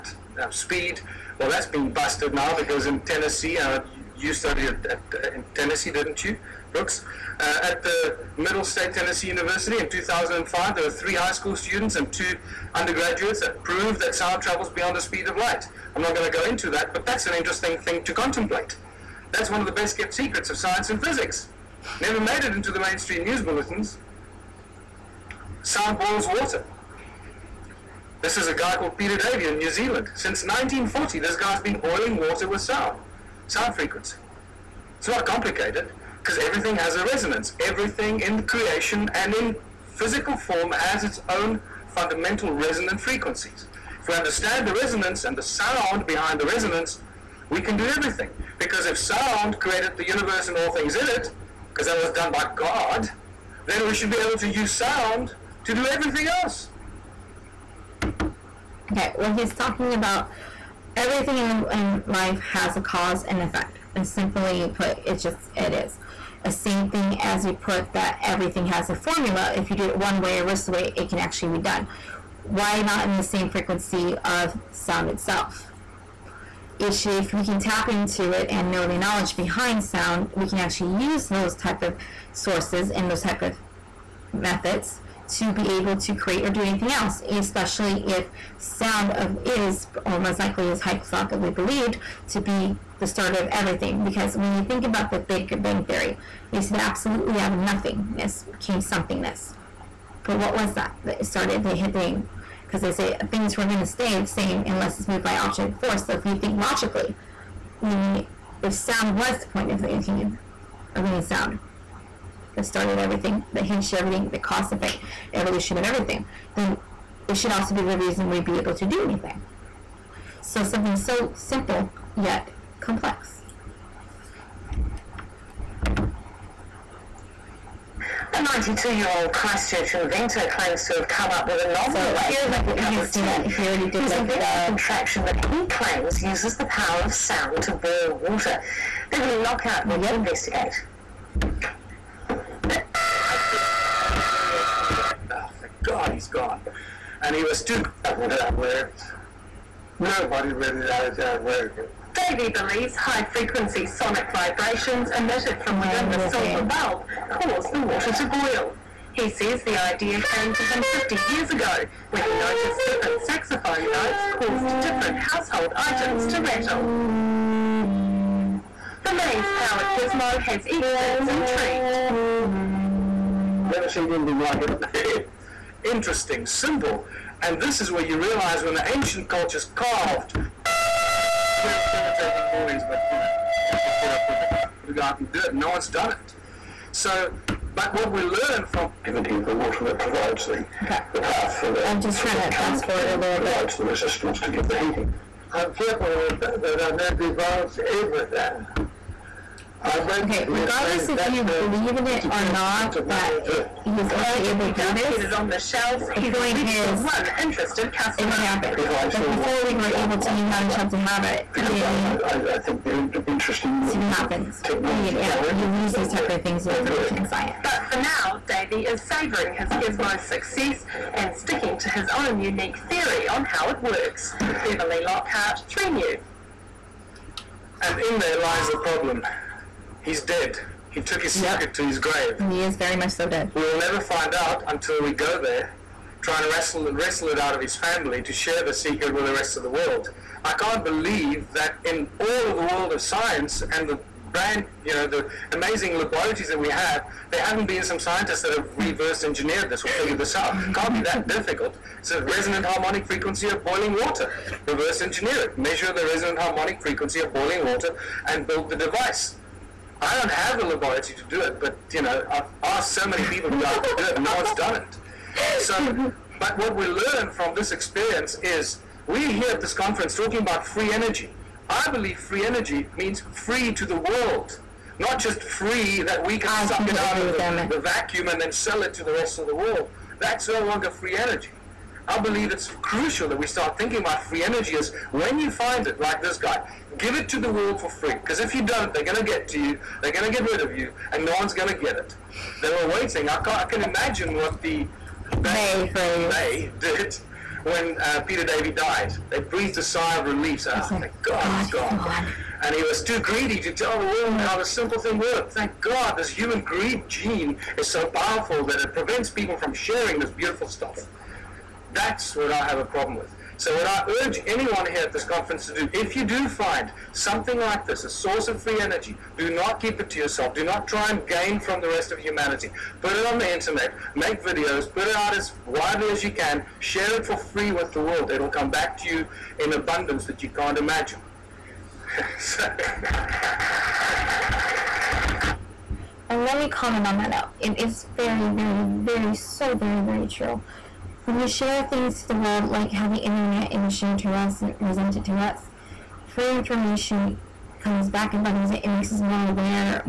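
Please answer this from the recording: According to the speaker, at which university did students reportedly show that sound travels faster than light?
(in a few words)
Middle State Tennessee University.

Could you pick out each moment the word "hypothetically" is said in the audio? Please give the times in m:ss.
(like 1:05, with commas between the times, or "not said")
1:30.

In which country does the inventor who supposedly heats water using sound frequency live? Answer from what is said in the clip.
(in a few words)
New Zealand.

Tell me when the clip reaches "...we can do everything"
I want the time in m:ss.
0:47.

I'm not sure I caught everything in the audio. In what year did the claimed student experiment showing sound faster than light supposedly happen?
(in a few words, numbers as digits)
2005.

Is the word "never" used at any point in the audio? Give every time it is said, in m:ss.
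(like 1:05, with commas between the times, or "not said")
0:22, 2:53, 3:53.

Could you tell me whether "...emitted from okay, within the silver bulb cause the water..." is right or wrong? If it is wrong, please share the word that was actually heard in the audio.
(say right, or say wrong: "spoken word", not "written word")
right.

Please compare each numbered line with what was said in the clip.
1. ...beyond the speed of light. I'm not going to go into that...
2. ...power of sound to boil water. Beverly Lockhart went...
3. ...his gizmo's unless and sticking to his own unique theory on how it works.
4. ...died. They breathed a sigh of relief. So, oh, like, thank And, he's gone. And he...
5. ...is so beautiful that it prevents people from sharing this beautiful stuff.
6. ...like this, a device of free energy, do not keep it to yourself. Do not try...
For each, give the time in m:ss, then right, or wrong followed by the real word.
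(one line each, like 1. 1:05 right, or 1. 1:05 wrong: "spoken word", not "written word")
1. 0:14 right
2. 2:16 right
3. 3:39 wrong: "success", not "unless"
4. 4:58 wrong: "God", not "And"
5. 5:07 wrong: "powerful", not "beautiful"
6. 5:17 wrong: "source", not "device".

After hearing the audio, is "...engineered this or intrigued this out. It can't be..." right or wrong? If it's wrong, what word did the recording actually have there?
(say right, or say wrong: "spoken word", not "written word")
wrong: "figured", not "intrigued".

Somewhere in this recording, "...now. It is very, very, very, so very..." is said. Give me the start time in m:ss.
5:37.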